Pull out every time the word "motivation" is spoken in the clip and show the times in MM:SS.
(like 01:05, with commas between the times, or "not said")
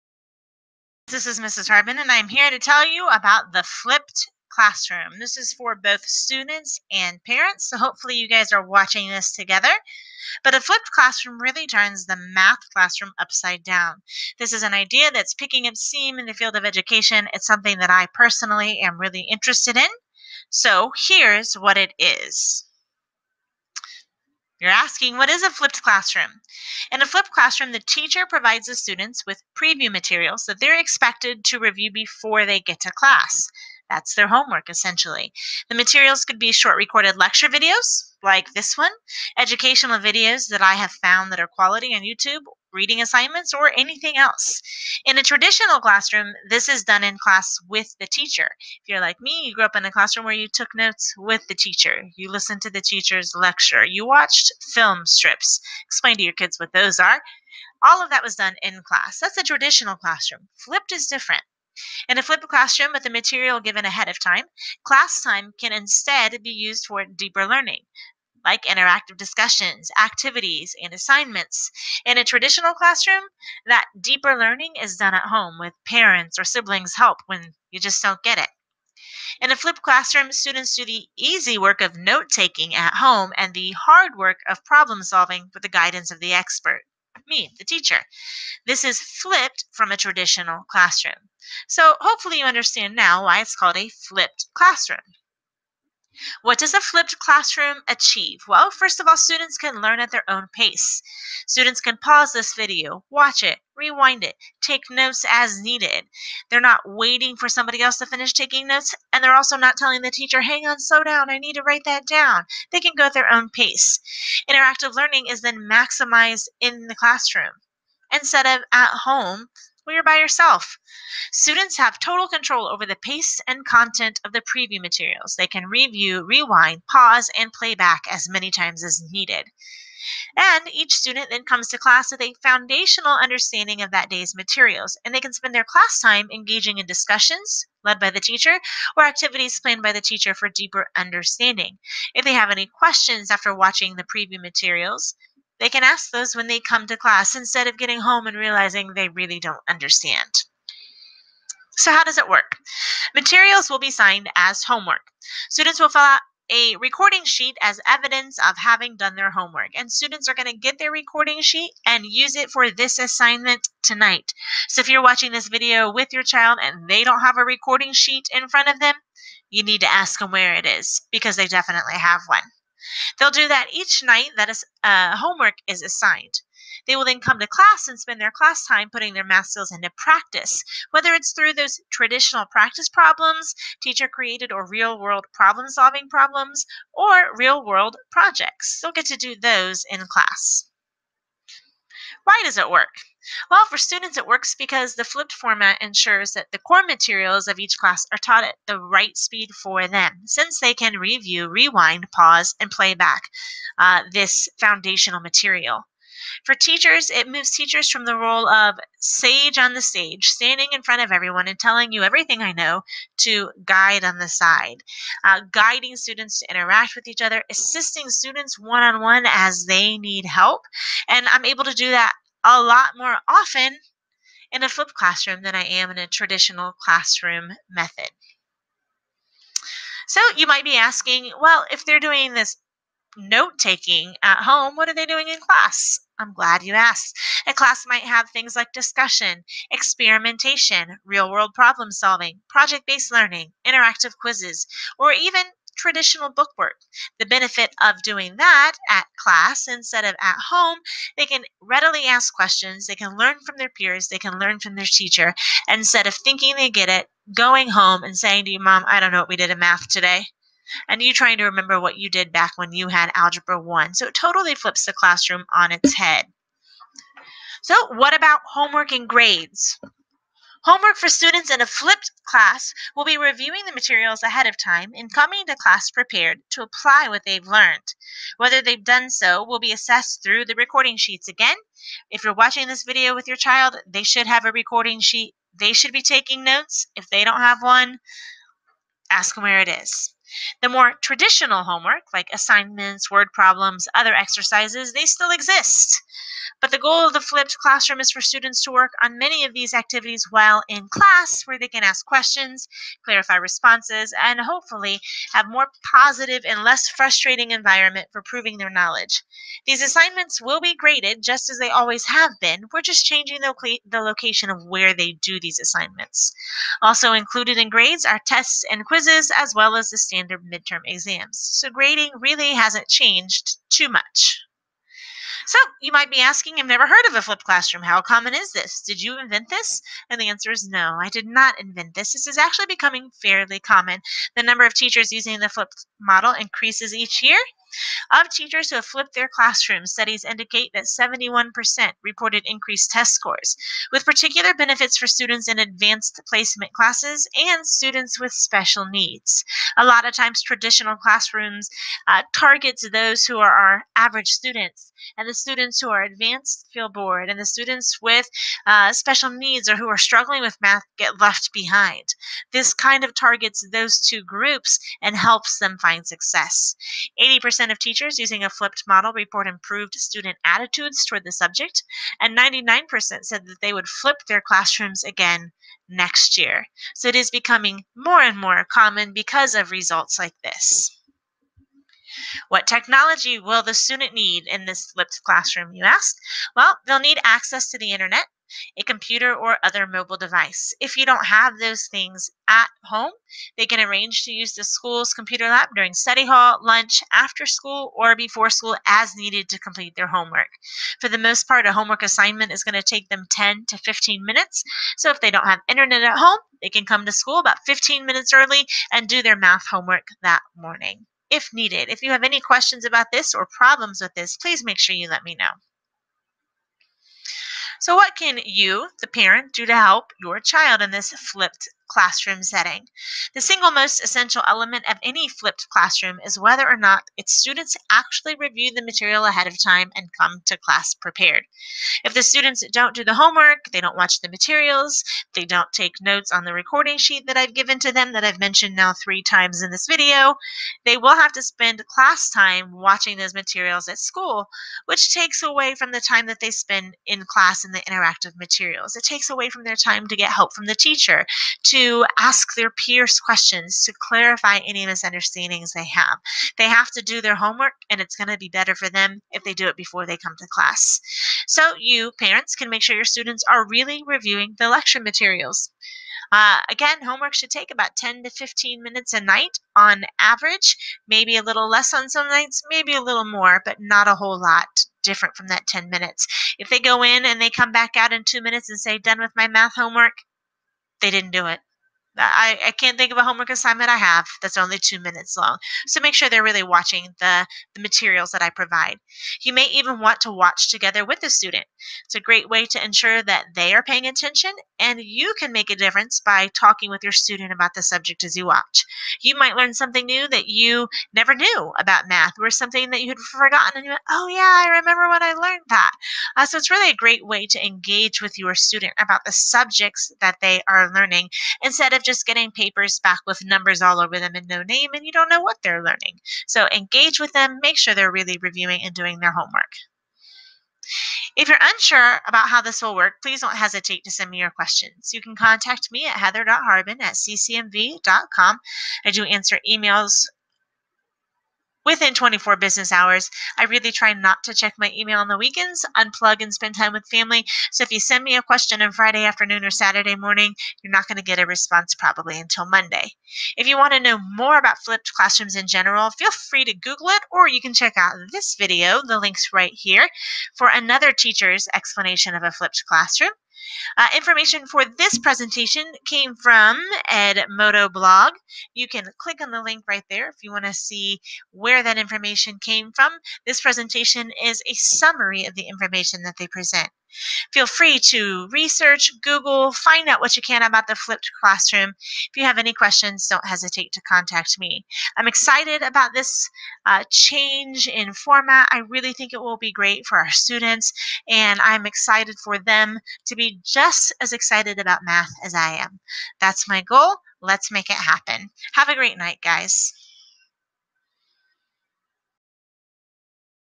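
not said.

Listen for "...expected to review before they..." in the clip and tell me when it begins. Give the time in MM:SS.
00:30.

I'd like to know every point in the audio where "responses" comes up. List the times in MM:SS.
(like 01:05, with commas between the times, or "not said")
05:03, 09:01.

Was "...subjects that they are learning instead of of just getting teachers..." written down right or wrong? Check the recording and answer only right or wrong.
wrong.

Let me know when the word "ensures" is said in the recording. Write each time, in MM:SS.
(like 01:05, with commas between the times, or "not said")
03:15, 08:12.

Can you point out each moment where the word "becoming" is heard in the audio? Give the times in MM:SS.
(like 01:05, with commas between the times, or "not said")
05:32, 06:17.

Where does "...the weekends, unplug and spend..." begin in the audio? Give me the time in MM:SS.
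08:55.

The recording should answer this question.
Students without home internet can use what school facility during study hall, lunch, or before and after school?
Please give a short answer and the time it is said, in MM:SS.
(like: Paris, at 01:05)
computer lab, at 06:35.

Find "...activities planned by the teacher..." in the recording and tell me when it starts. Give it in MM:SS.
02:19.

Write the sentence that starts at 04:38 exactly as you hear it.
Whether they've done so will be assessed through the recording sheets again.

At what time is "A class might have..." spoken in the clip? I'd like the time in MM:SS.
03:57.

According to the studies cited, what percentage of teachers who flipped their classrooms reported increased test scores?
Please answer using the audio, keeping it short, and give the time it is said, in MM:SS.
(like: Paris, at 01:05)
71%, at 05:40.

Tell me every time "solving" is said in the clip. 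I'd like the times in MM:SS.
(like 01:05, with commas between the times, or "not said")
01:25, 03:05, 04:01.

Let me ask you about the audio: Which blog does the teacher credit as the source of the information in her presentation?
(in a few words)
Edmodo blog.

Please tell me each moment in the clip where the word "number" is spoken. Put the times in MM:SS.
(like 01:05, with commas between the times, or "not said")
05:34, 08:33.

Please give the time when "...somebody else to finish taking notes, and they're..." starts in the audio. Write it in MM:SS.
01:47.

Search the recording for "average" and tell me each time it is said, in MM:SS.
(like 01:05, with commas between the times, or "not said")
05:53, 07:50.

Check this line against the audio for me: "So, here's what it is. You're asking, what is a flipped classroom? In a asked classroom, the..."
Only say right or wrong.
wrong.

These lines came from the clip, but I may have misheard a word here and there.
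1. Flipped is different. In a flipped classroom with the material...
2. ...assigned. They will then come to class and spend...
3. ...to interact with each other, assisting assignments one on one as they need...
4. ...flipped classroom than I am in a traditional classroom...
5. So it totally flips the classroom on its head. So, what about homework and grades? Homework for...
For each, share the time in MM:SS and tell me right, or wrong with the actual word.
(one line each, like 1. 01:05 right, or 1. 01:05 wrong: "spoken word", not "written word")
1. 01:00 right
2. 02:55 right
3. 03:36 wrong: "students", not "assignments"
4. 03:44 right
5. 04:23 right.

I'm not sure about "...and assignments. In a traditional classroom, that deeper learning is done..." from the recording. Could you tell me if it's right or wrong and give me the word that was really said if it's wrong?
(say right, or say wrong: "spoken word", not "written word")
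right.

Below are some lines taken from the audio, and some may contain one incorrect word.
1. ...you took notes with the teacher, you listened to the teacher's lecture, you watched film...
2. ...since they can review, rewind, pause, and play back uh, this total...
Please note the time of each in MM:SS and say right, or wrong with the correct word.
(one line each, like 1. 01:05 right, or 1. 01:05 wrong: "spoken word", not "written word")
1. 00:50 right
2. 03:20 wrong: "foundational", not "total".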